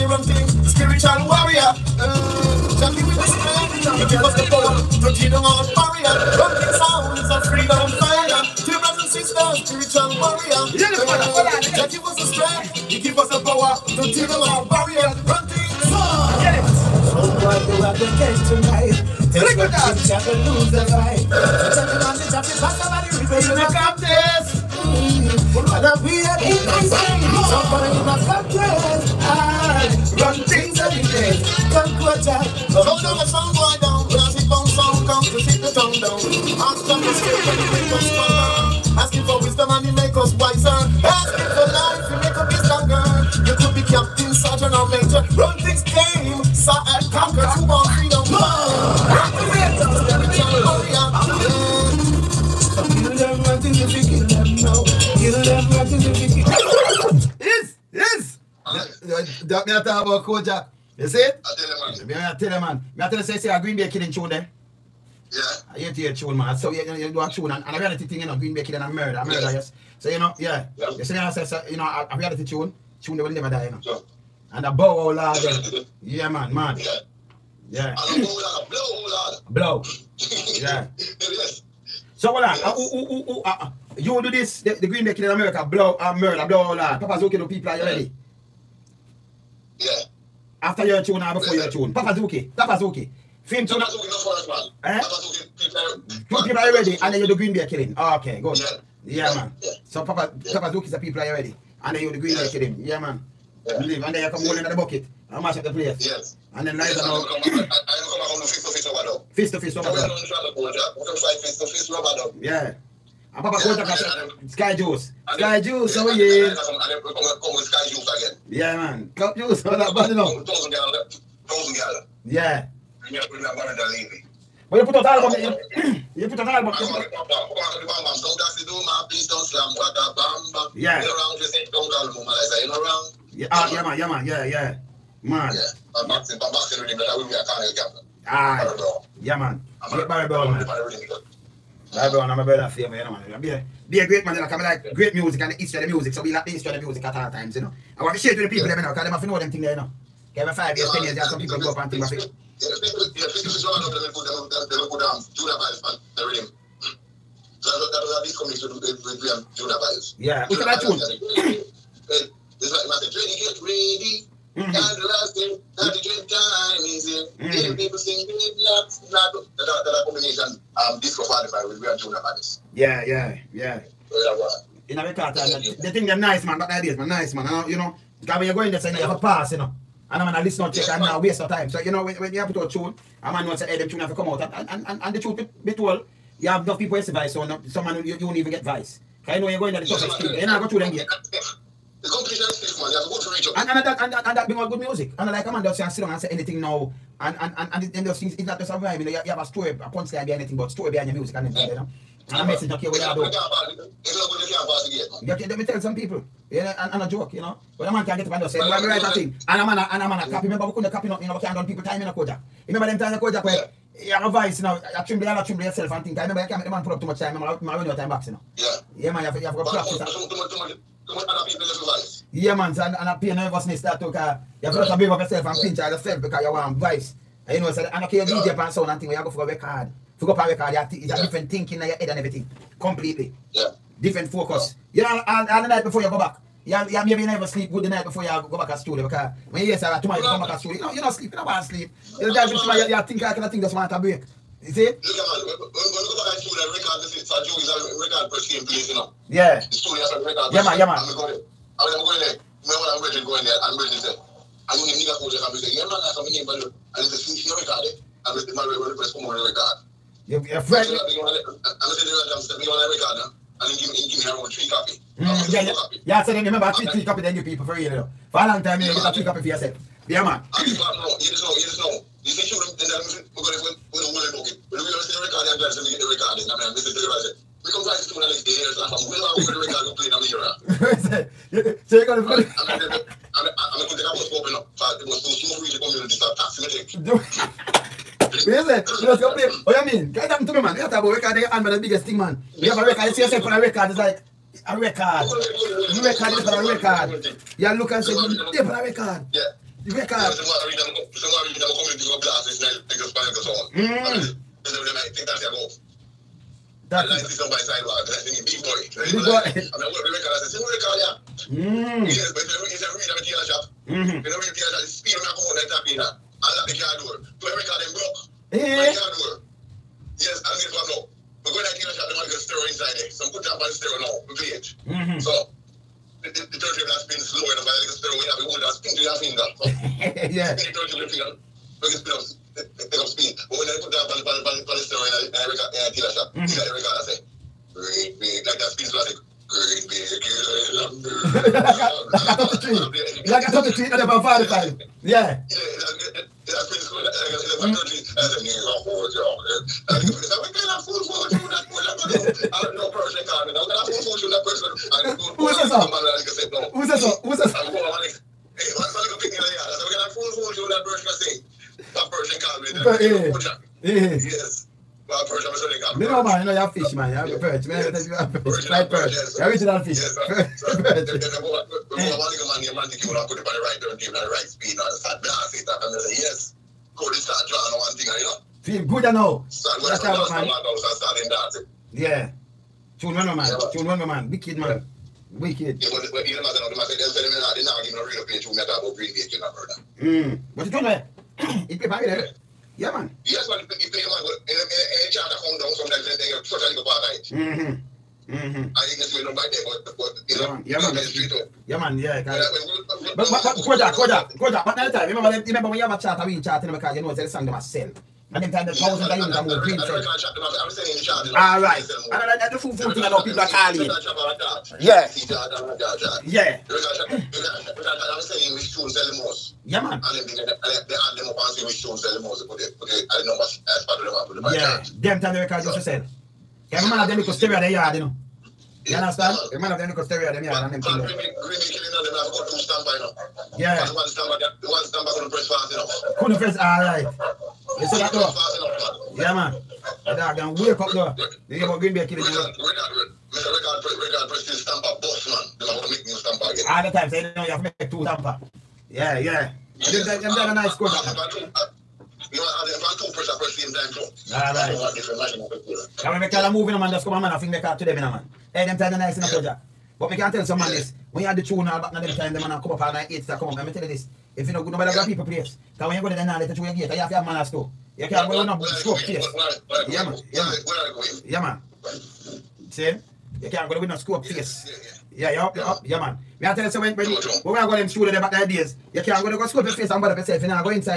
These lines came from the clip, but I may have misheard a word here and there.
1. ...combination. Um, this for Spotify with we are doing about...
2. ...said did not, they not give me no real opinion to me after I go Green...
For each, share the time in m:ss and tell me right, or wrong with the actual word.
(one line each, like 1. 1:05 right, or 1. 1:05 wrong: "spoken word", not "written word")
1. 2:50 right
2. 6:26 right.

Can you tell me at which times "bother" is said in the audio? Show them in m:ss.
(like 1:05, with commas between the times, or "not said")
8:00.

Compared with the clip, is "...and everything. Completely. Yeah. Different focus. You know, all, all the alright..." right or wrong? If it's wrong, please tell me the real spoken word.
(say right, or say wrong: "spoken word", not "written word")
wrong: "night", not "alright".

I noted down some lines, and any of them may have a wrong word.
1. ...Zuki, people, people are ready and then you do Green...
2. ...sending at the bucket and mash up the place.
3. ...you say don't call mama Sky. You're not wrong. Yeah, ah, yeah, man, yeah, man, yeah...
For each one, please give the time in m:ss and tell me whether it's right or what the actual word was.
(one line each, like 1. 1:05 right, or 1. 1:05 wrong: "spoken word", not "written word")
1. 1:35 right
2. 1:44 wrong: "holding", not "sending"
3. 2:11 wrong: "Liza", not "Sky".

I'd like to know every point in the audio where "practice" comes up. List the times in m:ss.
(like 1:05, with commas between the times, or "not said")
3:39, 4:37.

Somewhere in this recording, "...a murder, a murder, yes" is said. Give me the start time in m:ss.
1:08.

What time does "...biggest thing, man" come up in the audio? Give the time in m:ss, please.
4:51.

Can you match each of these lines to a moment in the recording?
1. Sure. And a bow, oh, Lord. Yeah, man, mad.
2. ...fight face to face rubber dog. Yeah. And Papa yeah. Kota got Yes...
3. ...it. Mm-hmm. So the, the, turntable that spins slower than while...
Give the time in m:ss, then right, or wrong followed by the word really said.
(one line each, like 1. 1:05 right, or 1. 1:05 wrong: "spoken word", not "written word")
1. 1:13 right
2. 1:51 wrong: "Sky", not "Yes"
3. 5:24 right.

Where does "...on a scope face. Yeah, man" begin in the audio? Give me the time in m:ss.
7:48.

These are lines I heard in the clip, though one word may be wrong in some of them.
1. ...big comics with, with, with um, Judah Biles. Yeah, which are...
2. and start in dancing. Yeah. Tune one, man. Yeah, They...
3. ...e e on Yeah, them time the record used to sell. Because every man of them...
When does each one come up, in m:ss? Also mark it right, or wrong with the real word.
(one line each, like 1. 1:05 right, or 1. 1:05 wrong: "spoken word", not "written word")
1. 2:38 right
2. 6:20 wrong: "Tune", not "They"
3. 7:04 right.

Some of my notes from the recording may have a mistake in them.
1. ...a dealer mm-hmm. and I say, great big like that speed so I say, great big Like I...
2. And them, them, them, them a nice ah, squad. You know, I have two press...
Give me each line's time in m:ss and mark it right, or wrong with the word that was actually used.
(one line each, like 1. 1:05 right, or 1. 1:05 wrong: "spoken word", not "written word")
1. 5:35 right
2. 7:29 right.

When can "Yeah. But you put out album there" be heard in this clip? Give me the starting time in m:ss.
2:02.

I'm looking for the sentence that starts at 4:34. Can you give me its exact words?
But if we don't see the record, I'm glad to get the record.